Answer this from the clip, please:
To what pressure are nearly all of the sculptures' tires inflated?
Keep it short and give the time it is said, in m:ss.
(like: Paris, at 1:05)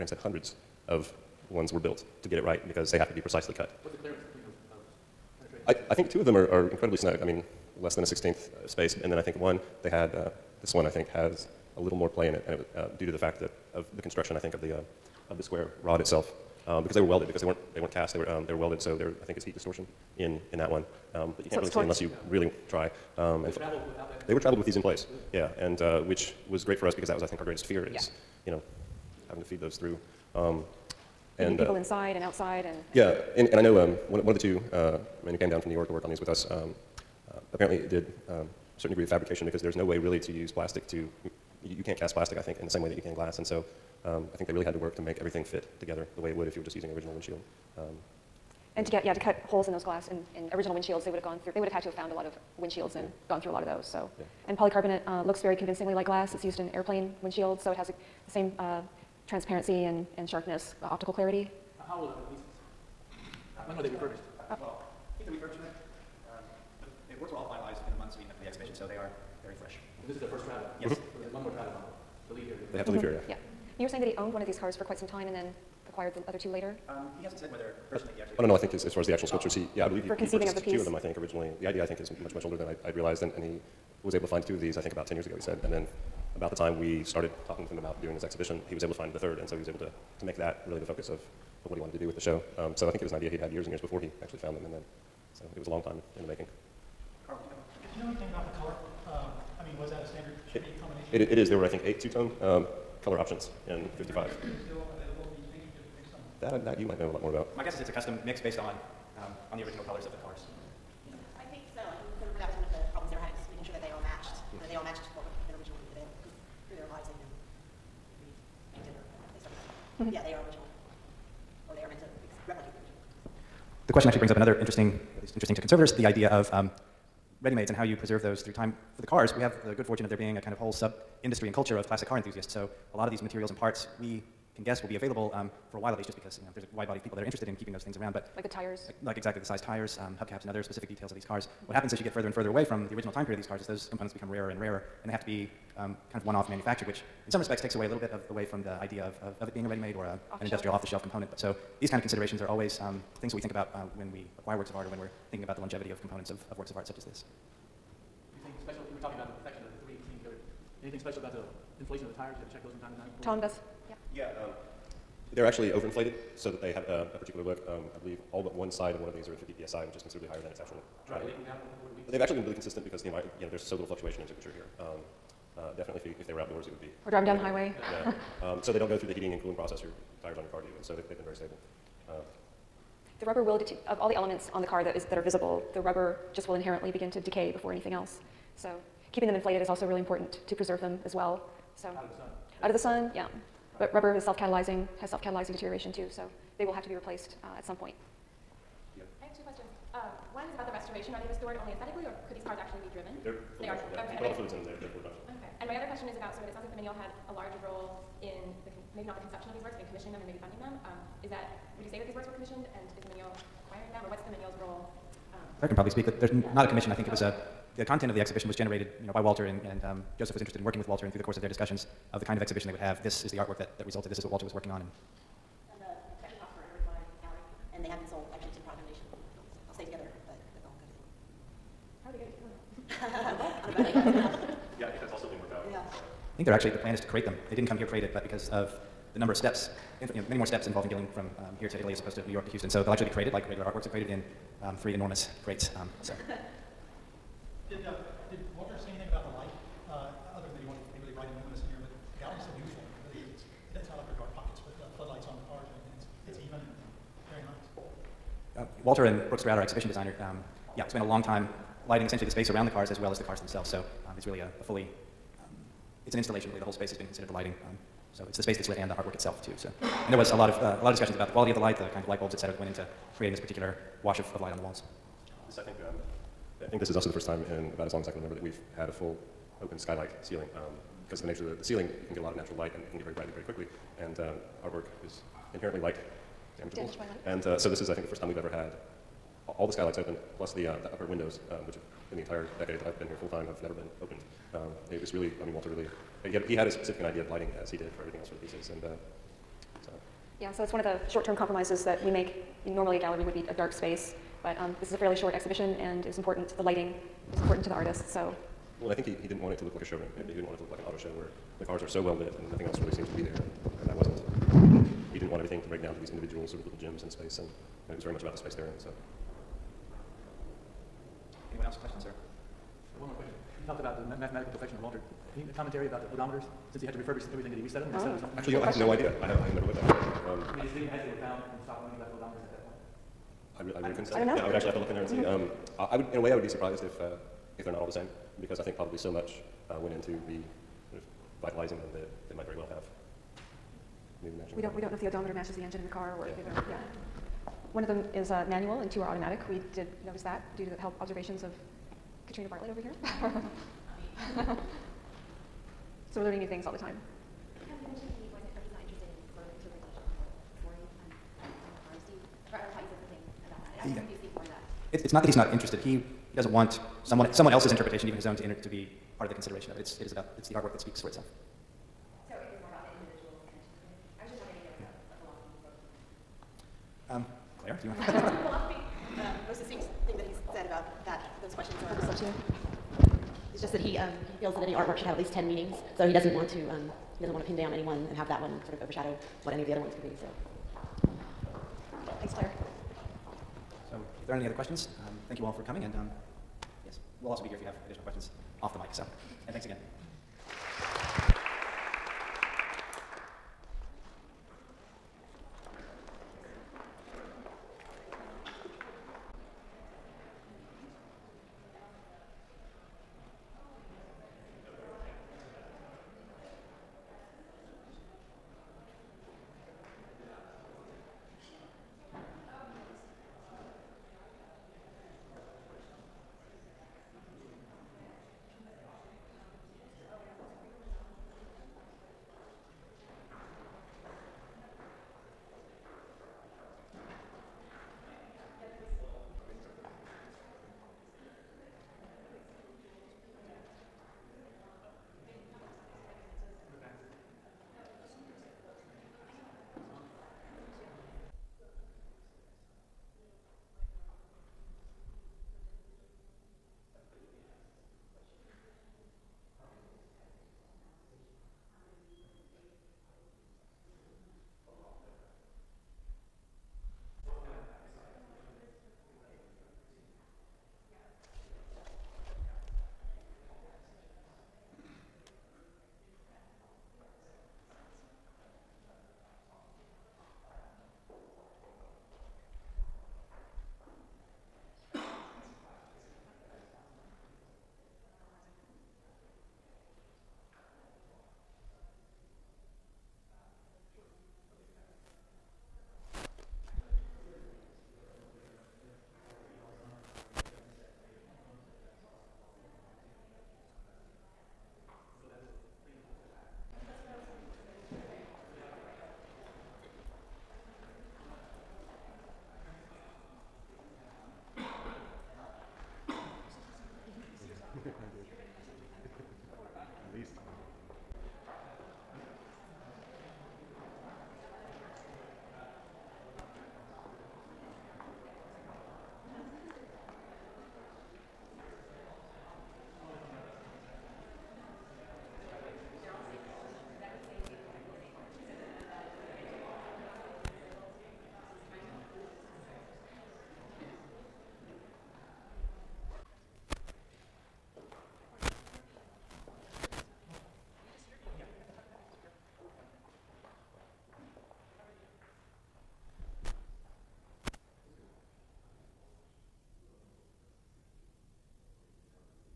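50 psi, at 2:49.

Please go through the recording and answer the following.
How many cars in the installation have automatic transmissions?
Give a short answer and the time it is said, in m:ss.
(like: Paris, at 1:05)
2, at 5:48.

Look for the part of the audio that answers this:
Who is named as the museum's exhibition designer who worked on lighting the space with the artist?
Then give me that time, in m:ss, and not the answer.
4:19.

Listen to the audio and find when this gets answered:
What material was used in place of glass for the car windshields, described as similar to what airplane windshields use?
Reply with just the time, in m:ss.
0:54.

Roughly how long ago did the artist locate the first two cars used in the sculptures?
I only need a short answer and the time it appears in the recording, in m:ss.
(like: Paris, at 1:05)
About ten years ago, at 1:24.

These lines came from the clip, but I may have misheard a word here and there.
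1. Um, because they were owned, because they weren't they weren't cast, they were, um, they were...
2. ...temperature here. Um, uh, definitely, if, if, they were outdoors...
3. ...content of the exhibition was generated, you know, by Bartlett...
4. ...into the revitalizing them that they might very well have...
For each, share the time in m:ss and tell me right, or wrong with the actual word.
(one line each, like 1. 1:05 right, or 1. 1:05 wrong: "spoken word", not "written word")
1. 0:16 wrong: "welded", not "owned"
2. 2:54 right
3. 3:37 wrong: "Walter", not "Bartlett"
4. 5:39 right.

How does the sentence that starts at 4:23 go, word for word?
So um, it's really a, a fully, um, it's an installation really.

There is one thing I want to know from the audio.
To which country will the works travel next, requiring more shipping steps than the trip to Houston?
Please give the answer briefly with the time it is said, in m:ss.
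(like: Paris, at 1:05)
Italy, at 4:01.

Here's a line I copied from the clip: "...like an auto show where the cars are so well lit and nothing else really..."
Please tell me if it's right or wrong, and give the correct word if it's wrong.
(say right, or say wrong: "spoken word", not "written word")
right.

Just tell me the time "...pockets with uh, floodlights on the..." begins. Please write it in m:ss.
4:14.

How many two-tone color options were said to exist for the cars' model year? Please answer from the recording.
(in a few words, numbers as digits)
8.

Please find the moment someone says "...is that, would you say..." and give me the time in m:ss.
3:31.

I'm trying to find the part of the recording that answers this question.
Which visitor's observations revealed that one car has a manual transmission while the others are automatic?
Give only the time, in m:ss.
5:52.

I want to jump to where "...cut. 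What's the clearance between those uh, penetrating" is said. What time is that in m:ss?
0:03.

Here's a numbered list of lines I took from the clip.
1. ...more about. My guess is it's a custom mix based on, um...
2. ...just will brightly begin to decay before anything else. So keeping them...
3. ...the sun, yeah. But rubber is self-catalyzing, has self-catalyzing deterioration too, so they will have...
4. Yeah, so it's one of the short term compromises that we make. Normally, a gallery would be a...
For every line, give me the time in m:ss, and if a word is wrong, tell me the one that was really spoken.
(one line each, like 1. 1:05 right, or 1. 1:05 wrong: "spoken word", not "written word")
1. 1:47 right
2. 3:06 wrong: "inherently", not "brightly"
3. 3:12 right
4. 5:00 right.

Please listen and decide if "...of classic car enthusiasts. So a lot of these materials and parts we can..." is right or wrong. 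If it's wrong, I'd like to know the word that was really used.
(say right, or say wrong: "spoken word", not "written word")
right.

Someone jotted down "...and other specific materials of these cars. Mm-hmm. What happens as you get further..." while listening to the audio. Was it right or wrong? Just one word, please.
wrong.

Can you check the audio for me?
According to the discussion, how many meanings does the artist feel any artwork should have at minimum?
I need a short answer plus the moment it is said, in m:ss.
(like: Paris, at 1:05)
10, at 6:25.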